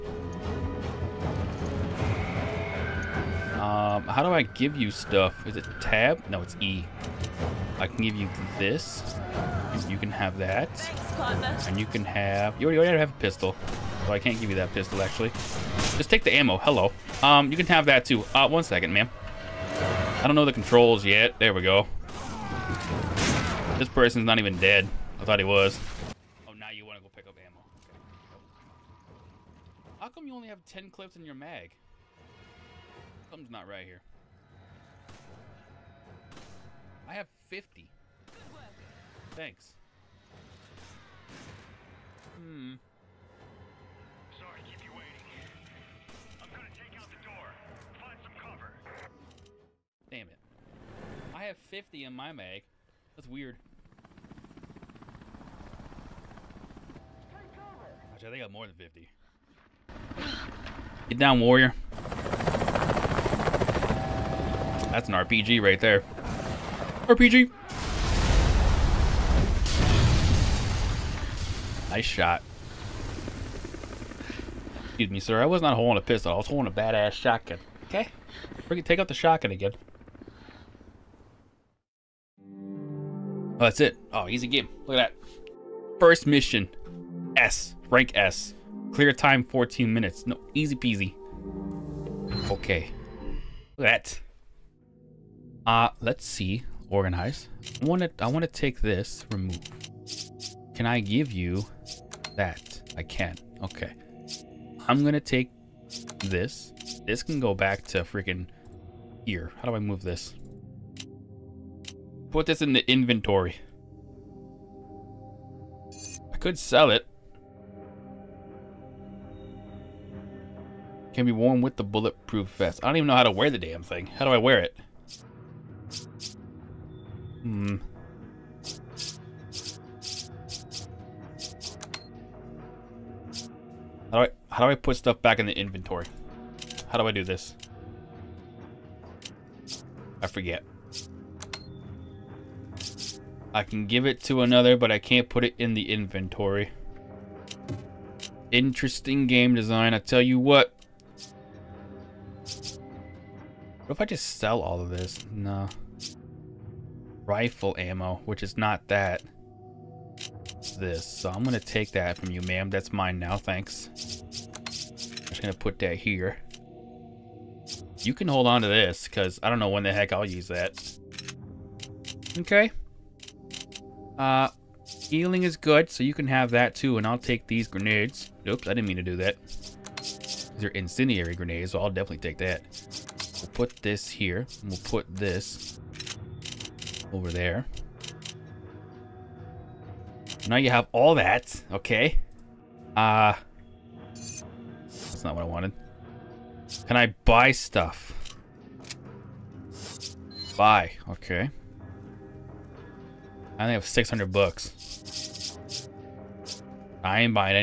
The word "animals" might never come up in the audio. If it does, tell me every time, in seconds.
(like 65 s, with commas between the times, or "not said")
not said.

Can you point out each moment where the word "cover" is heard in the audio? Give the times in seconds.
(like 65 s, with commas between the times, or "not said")
48 s, 57 s.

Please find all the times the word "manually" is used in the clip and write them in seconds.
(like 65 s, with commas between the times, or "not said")
not said.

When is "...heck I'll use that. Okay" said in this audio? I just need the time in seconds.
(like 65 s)
169 s.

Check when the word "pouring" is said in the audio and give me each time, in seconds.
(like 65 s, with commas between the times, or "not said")
not said.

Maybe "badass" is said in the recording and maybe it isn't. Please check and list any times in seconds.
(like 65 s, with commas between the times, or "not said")
76 s.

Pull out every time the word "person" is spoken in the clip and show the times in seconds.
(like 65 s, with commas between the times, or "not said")
23 s.